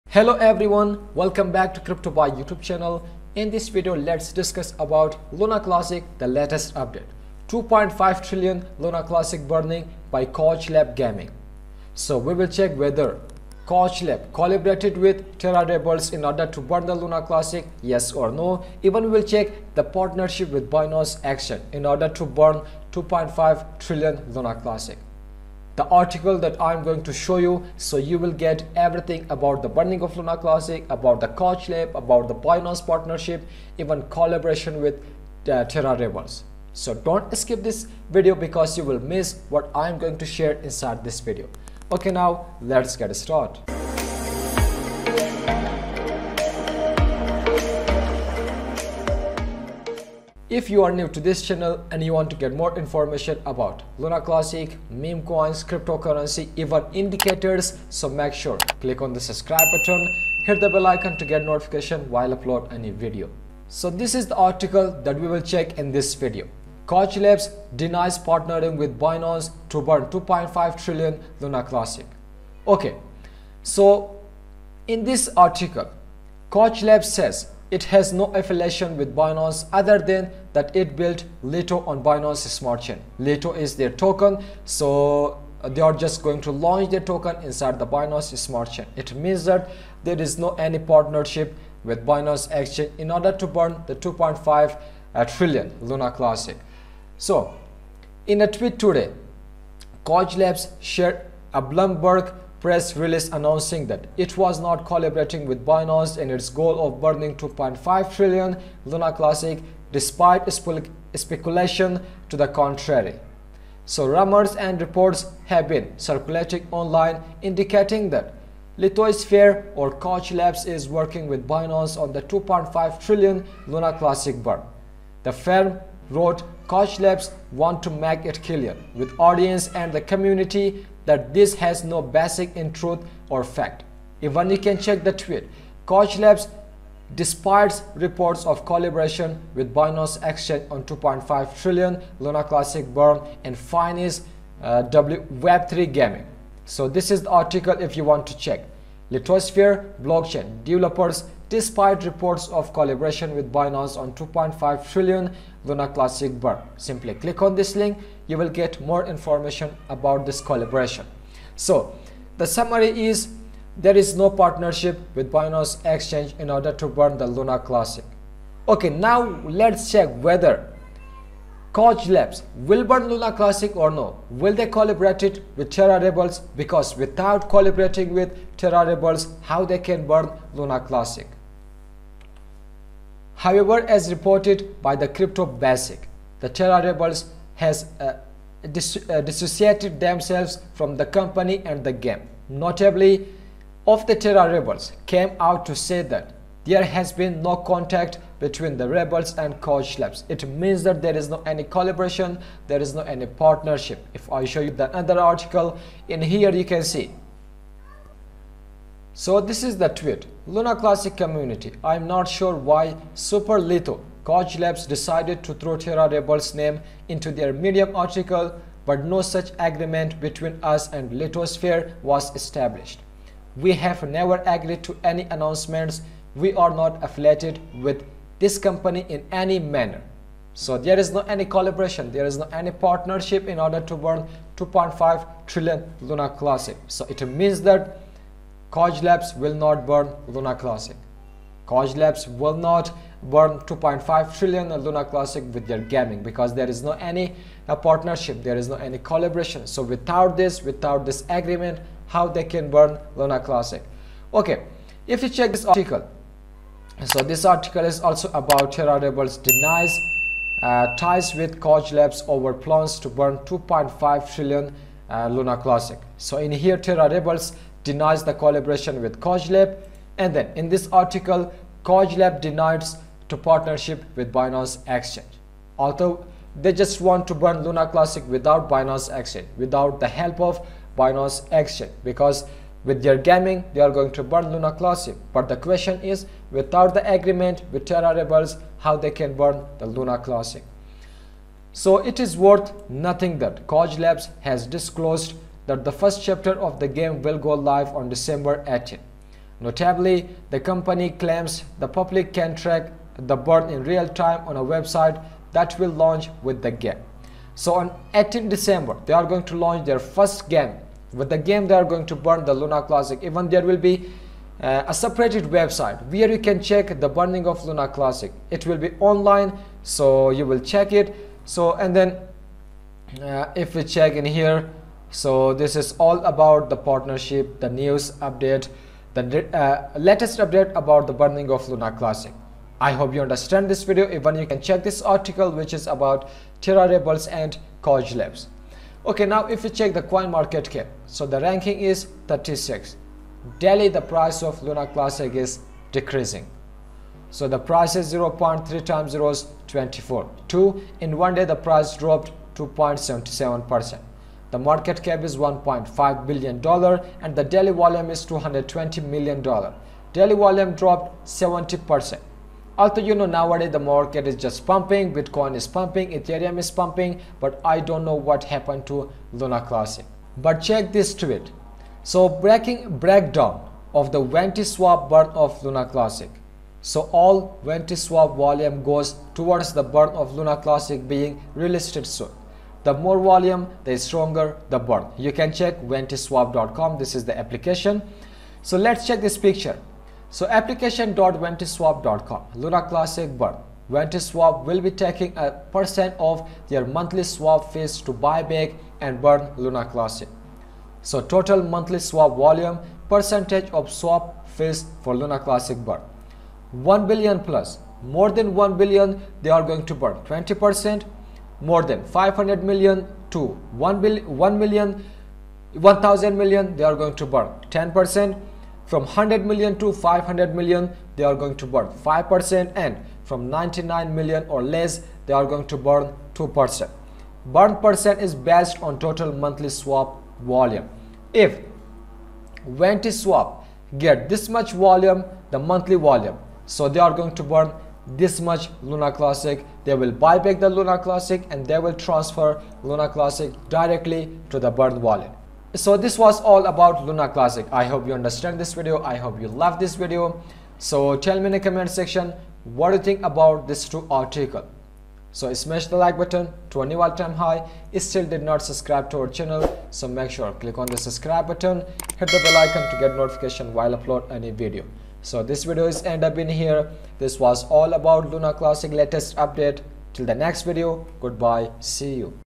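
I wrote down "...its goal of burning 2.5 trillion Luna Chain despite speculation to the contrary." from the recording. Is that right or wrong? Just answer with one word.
wrong.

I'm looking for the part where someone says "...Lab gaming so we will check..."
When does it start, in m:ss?
0:10.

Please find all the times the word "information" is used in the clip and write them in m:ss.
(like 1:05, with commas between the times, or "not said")
0:52, 2:39.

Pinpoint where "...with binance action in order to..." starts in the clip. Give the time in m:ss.
0:20.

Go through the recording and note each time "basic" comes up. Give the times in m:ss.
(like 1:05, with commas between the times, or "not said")
2:12, 3:05.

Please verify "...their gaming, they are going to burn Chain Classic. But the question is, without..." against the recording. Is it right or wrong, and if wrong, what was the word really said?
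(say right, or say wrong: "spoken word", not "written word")
wrong: "Luna", not "Chain".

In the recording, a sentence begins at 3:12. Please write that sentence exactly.
Notably, of the Terra Rebels came out to say that there has been no contact between the rebels and Kaj Labs.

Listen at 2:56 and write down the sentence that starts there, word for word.
Because without collaborating with Terra Rebels, how they can burn Luna Classic?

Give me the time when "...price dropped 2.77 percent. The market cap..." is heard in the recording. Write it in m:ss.
5:51.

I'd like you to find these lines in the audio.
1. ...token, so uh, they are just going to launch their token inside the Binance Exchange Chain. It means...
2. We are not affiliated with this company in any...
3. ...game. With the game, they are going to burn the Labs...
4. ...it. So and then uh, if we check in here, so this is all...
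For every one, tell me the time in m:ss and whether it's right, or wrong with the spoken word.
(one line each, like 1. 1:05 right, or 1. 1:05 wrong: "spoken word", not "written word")
1. 1:23 wrong: "Smart", not "Exchange"
2. 3:46 right
3. 5:10 wrong: "Luna", not "Labs"
4. 5:20 right.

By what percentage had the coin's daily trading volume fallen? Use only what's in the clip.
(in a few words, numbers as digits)
70%.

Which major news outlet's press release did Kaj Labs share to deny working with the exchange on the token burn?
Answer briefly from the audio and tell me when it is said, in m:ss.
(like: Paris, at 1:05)
Bloomberg, at 1:41.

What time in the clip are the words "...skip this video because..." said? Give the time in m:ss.
0:37.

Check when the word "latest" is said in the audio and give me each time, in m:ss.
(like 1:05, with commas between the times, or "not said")
0:06, 5:29, 7:48.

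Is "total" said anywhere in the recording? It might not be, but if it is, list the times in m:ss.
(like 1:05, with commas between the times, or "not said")
6:41, 7:09.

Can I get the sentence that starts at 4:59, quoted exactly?
Notably, the company claims the public can track the bird in real time on a website that will launch with the game.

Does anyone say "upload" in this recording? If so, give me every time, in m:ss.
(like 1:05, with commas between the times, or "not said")
1:02, 7:43.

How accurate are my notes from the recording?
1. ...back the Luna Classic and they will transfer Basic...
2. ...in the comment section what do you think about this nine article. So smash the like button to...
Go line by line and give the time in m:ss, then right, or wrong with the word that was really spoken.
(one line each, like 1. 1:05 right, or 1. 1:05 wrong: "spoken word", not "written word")
1. 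7:20 wrong: "Luna", not "Basic"
2. 7:31 wrong: "two", not "nine".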